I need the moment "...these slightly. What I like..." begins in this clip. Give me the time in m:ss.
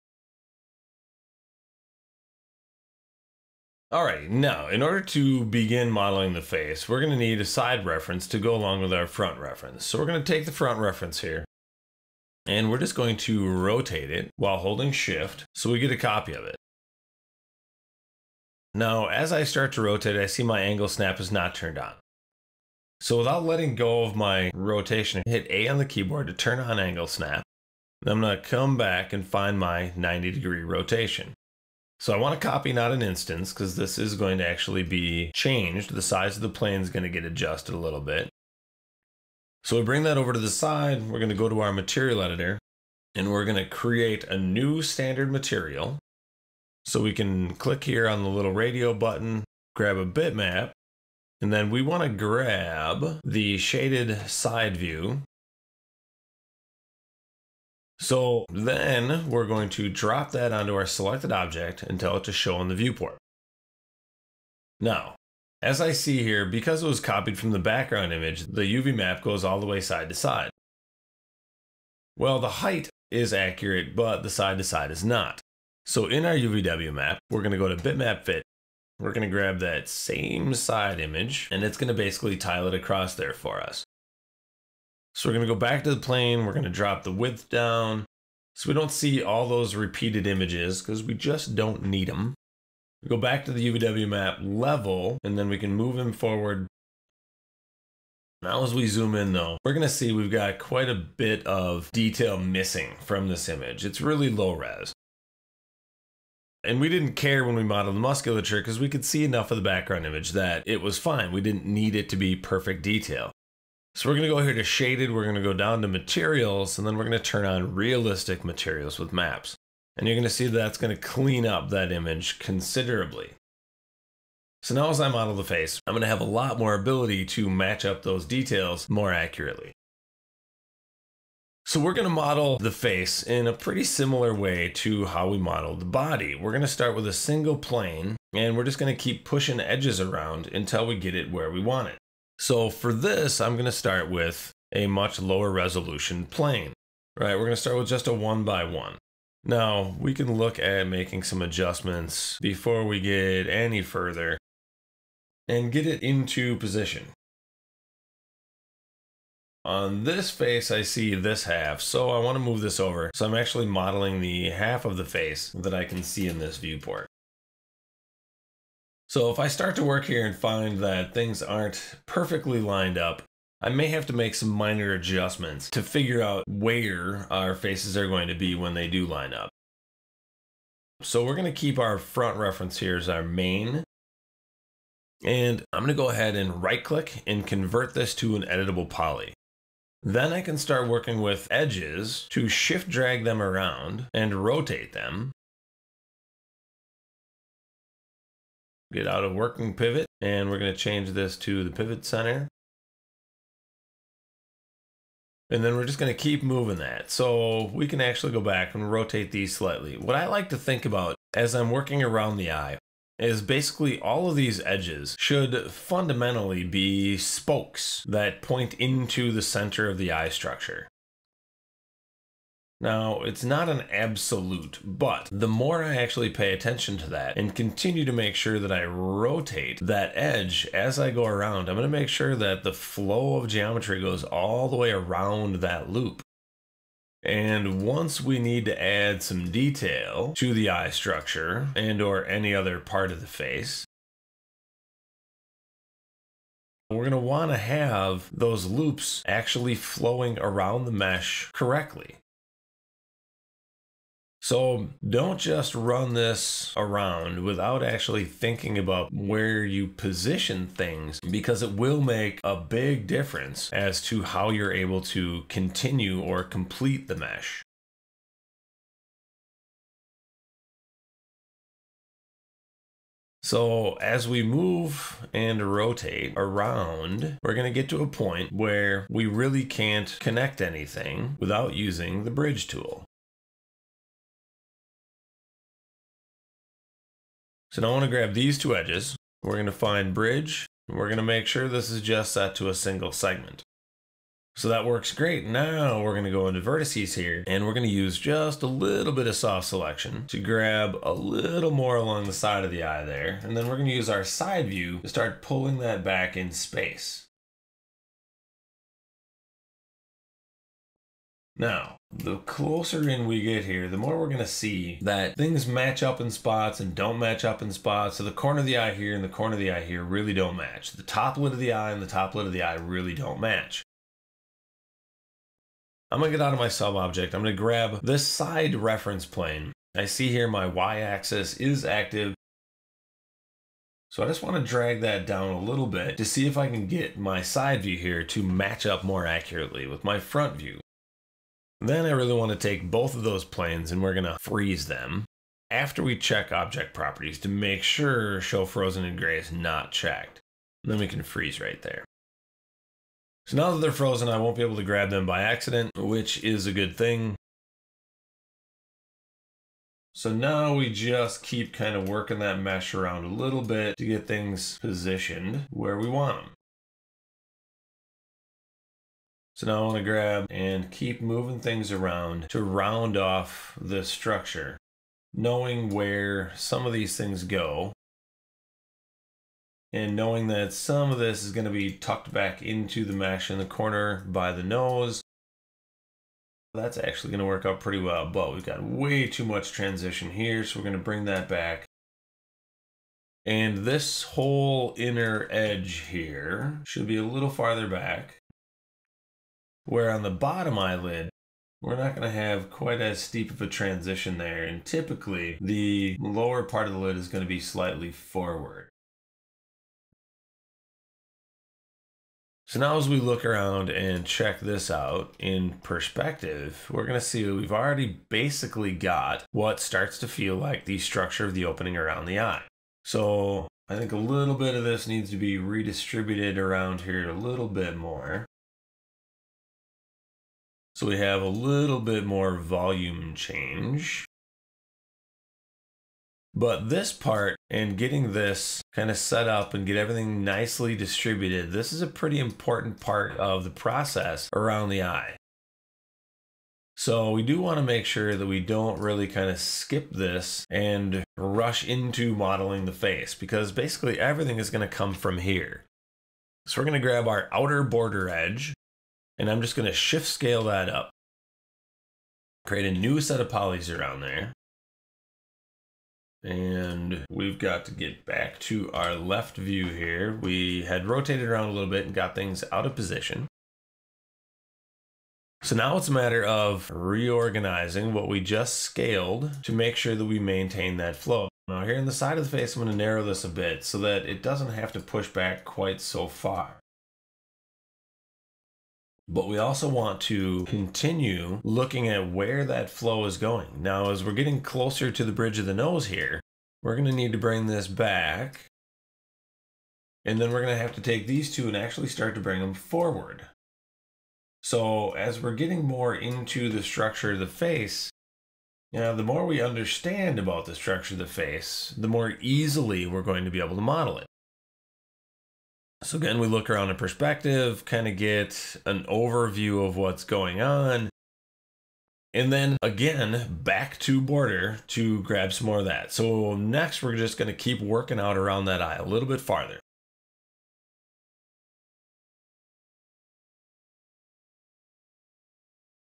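3:29.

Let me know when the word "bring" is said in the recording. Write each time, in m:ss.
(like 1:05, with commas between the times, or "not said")
0:39, 6:30, 8:17, 8:22.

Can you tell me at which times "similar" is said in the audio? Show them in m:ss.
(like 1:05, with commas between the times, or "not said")
2:13.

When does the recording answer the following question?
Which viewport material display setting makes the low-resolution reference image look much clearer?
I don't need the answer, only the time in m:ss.
1:57.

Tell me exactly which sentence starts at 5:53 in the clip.
So now that they're frozen, I won't be able to grab them by accident, which is a good thing.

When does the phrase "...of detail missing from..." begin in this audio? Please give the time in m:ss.
1:41.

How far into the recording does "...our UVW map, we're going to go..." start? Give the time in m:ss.
1:16.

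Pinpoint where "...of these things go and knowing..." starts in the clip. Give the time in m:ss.
6:16.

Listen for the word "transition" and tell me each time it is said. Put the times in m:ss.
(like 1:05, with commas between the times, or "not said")
6:29, 6:43.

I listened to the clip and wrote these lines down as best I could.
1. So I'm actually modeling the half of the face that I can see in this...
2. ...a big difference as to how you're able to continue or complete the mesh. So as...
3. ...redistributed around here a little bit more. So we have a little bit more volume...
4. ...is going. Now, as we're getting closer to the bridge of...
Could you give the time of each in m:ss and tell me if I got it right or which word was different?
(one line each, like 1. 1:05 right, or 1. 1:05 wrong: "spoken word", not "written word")
1. 2:43 right
2. 4:22 right
3. 7:05 right
4. 8:13 right.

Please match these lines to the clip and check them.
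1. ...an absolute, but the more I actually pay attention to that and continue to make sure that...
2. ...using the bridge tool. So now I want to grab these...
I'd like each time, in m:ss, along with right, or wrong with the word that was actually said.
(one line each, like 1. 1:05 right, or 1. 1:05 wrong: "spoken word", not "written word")
1. 3:43 right
2. 4:41 right.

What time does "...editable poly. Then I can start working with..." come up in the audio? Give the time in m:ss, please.
3:08.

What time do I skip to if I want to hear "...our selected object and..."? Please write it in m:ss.
1:00.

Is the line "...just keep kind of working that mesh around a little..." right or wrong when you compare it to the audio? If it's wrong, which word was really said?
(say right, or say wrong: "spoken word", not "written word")
right.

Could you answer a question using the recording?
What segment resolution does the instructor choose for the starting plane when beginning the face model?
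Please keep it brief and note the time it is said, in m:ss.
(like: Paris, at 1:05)
one by one, at 2:28.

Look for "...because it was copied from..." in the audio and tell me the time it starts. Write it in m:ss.
1:06.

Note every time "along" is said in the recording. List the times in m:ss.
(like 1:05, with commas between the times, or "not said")
0:08, 5:01.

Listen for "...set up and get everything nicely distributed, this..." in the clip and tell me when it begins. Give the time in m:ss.
7:19.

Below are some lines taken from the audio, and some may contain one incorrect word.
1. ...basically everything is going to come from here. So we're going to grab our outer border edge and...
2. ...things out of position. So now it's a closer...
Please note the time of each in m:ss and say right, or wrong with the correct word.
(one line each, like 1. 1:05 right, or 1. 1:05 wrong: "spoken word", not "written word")
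1. 7:33 right
2. 7:52 wrong: "matter", not "closer".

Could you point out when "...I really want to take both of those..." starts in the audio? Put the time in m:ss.
5:42.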